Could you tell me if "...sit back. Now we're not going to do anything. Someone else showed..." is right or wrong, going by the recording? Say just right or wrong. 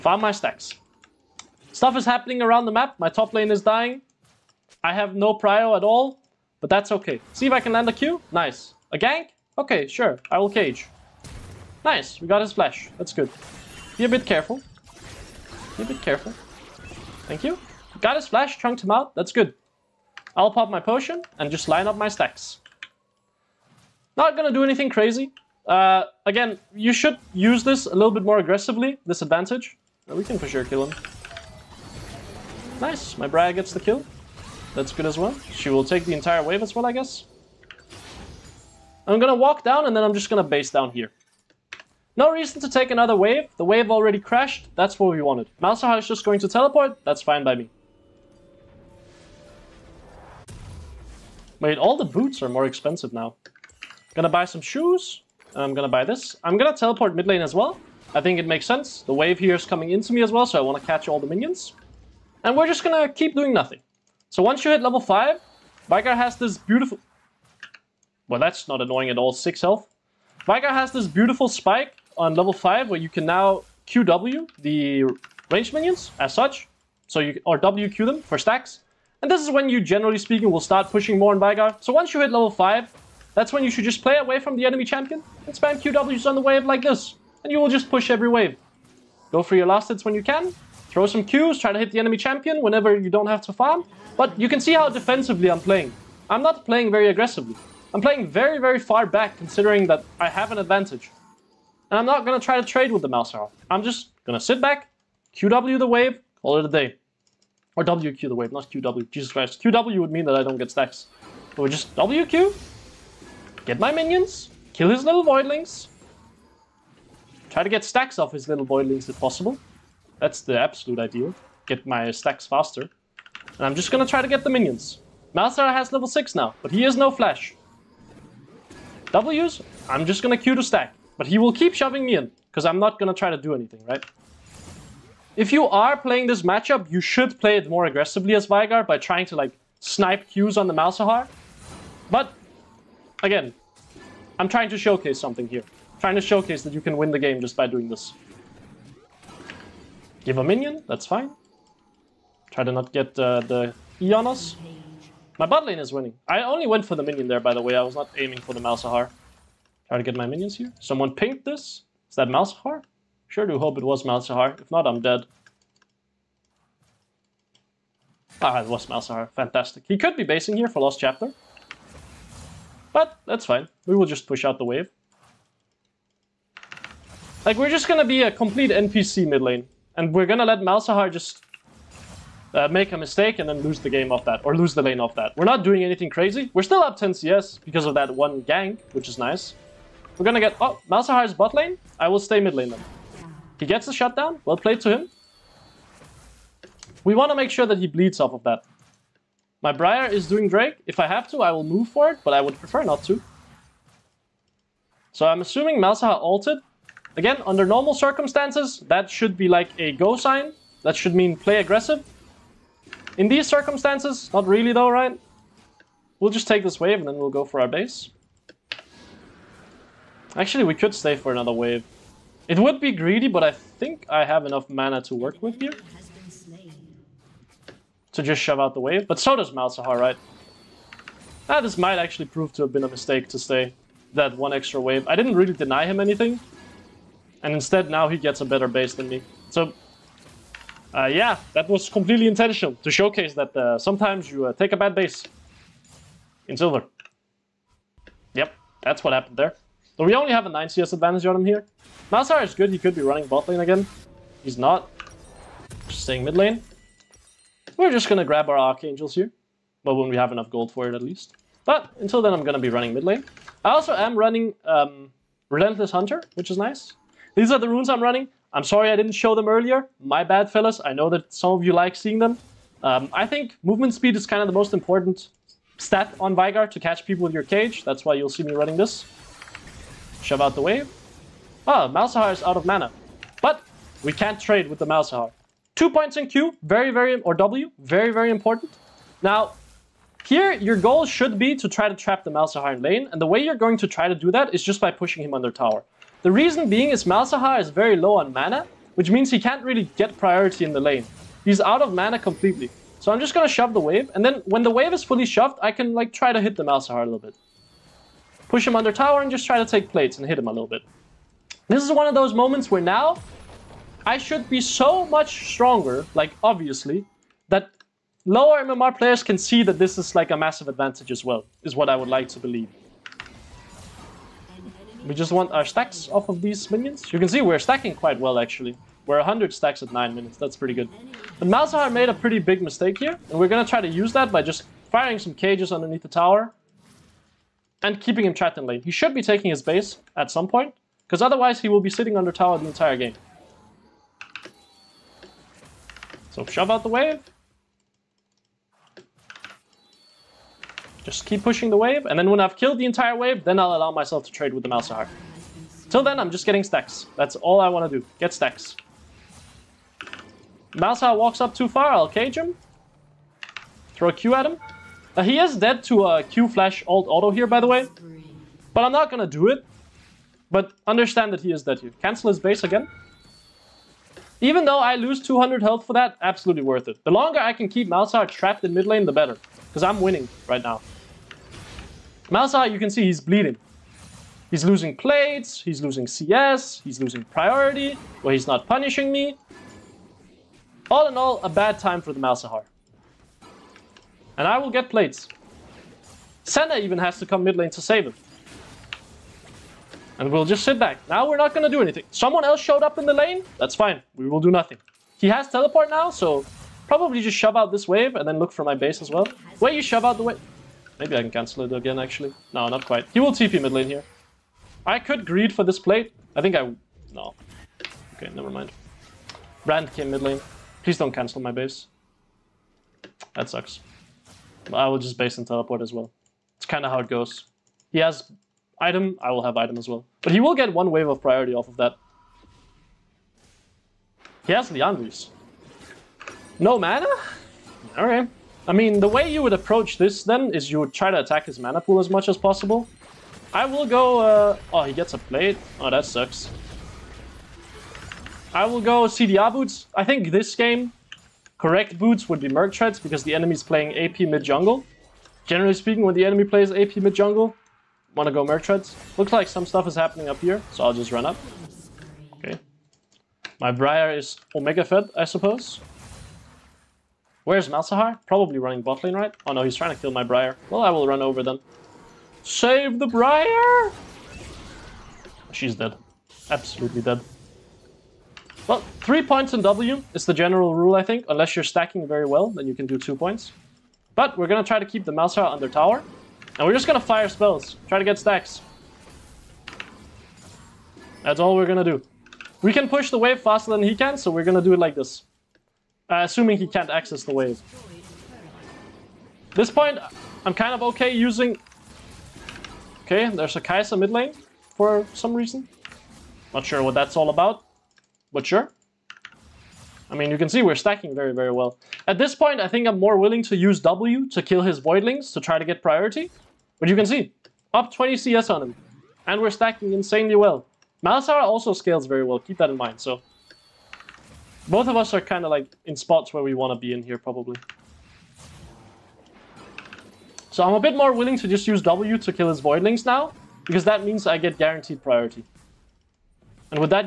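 right.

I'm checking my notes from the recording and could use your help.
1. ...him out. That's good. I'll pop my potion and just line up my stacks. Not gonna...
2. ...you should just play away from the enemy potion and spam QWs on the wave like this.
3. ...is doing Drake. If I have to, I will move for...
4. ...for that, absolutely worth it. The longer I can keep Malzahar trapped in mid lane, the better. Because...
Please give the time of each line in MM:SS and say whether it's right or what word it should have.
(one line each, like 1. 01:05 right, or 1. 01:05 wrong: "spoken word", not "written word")
1. 00:18 right
2. 01:23 wrong: "champion", not "potion"
3. 03:20 right
4. 06:15 right.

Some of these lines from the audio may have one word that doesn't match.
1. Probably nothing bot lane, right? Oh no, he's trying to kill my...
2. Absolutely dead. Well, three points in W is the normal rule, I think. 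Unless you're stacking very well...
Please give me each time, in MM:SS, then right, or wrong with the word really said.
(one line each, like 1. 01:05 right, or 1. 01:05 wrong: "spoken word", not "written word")
1. 07:48 wrong: "running", not "nothing"
2. 07:56 wrong: "general", not "normal".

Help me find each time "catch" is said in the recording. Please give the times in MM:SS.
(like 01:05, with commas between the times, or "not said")
01:00, 04:36.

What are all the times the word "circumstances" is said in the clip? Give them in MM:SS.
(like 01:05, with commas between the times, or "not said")
03:27, 03:33.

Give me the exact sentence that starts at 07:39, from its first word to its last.
Looks like some stuff is happening up here, so I'll just run up.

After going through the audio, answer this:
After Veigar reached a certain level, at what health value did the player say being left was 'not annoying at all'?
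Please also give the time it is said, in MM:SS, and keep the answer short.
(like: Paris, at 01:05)
6, at 01:09.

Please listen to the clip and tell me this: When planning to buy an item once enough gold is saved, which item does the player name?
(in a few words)
Archangels.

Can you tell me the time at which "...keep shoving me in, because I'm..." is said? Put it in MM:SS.
02:11.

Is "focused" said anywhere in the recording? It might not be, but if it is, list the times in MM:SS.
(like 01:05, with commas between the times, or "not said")
not said.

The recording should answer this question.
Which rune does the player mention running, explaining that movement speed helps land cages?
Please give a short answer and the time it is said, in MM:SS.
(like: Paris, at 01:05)
Relentless Hunter, at 04:25.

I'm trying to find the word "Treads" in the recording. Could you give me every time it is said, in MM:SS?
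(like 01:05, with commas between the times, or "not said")
07:32, 07:38.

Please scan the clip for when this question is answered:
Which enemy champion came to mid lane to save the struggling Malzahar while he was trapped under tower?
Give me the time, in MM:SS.
06:36.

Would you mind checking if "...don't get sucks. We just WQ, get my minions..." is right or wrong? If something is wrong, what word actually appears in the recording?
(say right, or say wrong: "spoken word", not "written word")
wrong: "stacks", not "sucks".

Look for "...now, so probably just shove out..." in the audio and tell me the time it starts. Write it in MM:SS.
06:45.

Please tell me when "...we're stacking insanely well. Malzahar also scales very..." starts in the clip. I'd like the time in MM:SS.
08:39.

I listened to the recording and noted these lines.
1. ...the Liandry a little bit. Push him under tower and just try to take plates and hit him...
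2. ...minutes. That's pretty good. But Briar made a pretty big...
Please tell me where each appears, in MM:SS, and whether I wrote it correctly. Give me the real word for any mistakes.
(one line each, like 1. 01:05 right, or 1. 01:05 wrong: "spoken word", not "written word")
1. 05:06 wrong: "Malzahar", not "Liandry"
2. 05:30 wrong: "Malzahar", not "Briar".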